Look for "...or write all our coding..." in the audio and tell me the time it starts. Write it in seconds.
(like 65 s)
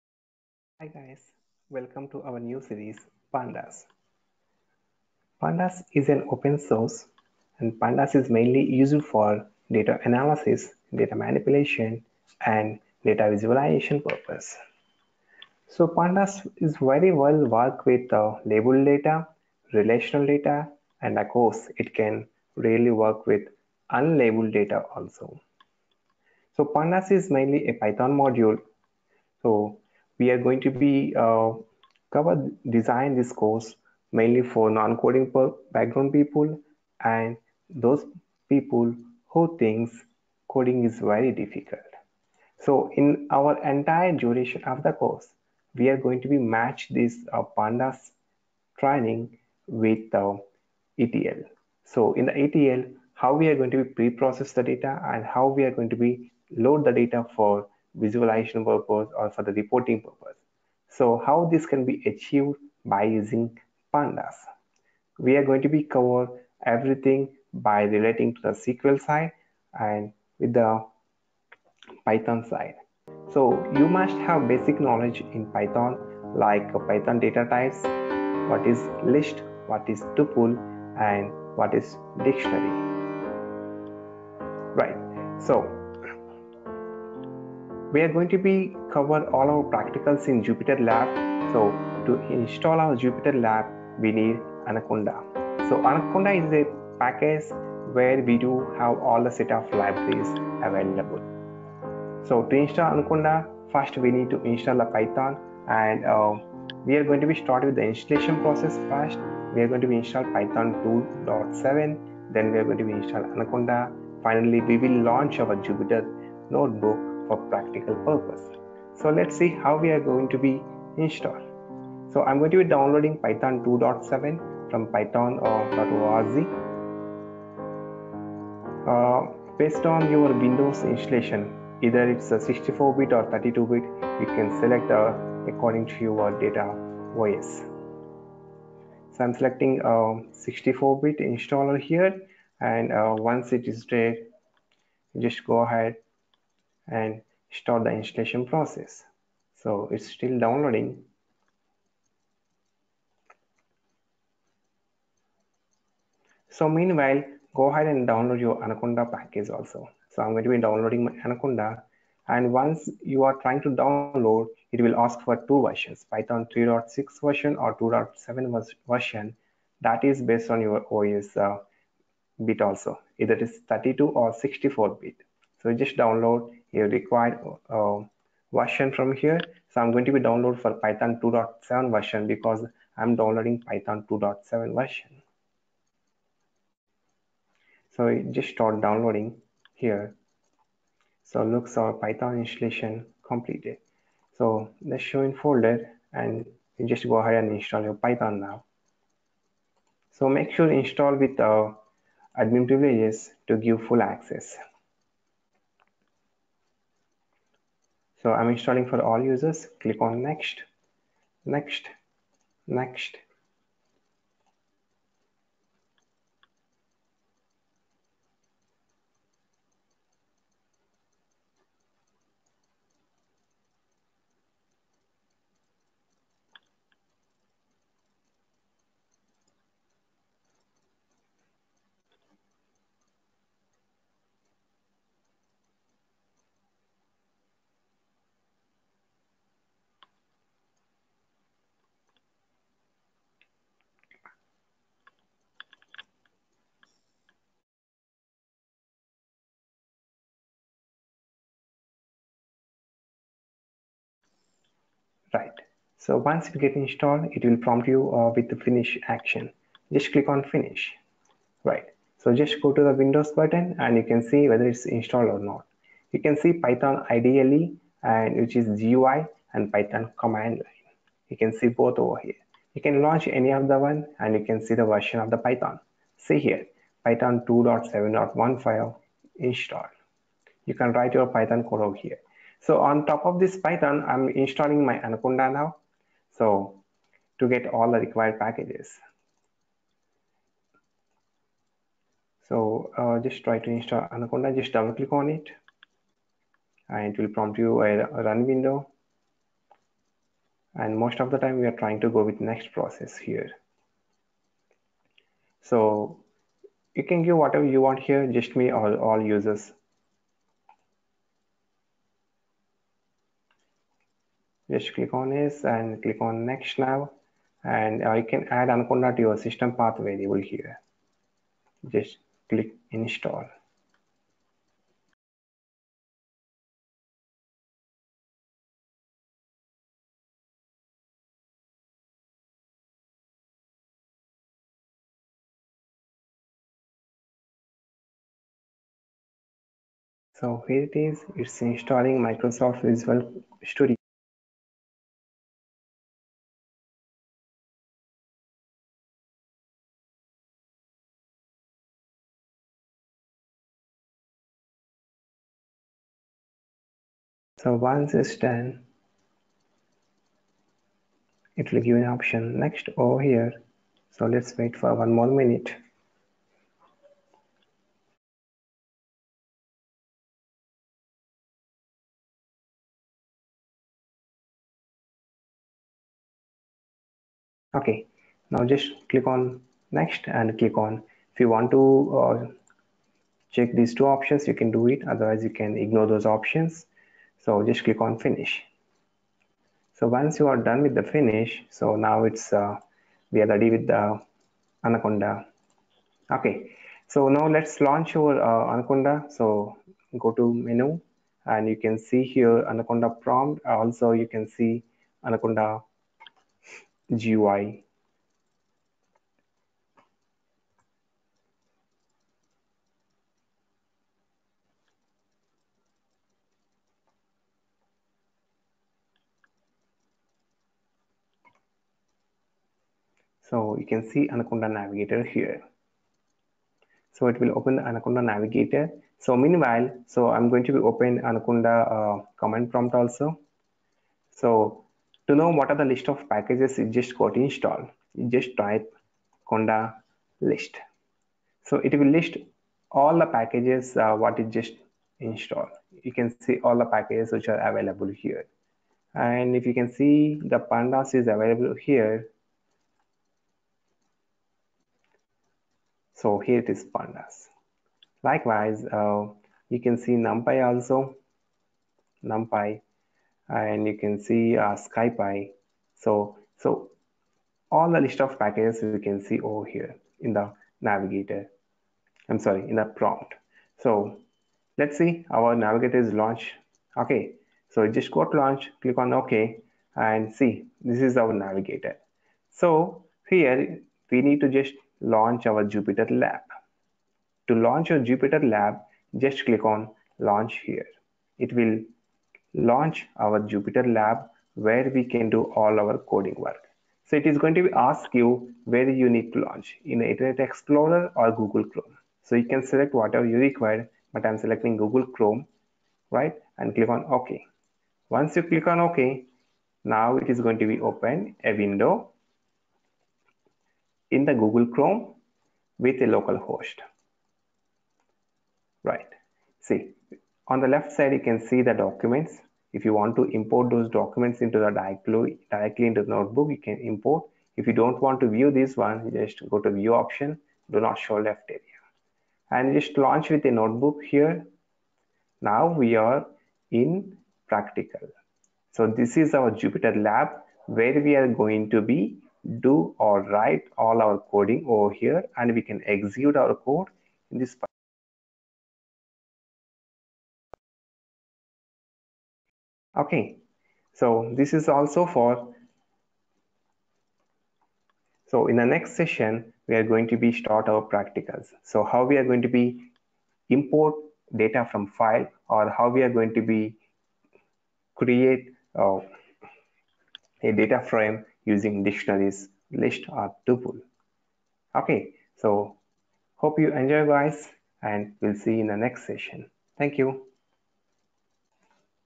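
542 s.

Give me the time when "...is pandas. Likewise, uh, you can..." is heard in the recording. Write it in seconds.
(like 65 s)
456 s.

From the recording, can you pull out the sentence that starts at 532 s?
And just launch with a notebook here.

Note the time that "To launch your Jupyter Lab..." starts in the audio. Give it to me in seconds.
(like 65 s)
487 s.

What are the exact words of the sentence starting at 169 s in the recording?
That is based on your OS uh, bit also.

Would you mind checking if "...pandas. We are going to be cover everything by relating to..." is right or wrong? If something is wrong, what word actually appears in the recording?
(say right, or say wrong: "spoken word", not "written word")
right.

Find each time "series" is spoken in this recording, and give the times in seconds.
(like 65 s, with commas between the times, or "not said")
2 s.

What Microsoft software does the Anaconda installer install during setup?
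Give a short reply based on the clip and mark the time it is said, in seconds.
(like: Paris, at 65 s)
Microsoft Visual Studio, at 342 s.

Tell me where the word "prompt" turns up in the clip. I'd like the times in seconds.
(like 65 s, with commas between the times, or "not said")
257 s, 297 s, 403 s, 432 s, 472 s.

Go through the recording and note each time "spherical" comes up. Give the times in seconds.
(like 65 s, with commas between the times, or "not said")
not said.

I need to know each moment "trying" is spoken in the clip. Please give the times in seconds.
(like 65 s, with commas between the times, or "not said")
163 s, 301 s.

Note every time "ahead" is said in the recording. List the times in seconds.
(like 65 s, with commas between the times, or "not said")
145 s, 157 s, 197 s.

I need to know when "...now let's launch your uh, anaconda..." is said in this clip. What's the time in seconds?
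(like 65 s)
397 s.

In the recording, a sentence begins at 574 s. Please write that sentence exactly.
Okay, so hope you enjoy guys and we'll see you in the next session.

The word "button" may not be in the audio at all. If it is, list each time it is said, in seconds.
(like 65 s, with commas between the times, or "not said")
263 s.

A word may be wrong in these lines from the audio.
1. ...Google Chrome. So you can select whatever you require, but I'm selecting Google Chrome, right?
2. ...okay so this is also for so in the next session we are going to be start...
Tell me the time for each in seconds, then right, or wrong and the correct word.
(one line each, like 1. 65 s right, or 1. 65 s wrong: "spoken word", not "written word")
1. 501 s right
2. 552 s right.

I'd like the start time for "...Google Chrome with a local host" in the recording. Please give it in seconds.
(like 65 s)
514 s.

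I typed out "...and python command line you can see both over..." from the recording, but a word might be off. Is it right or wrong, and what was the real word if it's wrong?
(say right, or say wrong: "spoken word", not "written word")
right.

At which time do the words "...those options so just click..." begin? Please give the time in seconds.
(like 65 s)
386 s.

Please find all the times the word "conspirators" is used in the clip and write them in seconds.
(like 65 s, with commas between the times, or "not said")
not said.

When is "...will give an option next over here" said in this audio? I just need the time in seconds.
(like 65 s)
361 s.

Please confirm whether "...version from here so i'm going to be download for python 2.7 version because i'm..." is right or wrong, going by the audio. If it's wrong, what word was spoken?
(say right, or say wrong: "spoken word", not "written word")
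right.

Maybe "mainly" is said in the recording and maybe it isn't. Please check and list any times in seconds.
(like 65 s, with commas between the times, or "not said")
8 s, 27 s, 34 s.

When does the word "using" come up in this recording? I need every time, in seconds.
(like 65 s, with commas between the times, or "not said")
63 s, 571 s.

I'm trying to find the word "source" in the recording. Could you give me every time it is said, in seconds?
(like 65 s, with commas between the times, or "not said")
6 s.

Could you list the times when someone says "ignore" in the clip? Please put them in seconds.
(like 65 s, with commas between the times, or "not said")
385 s.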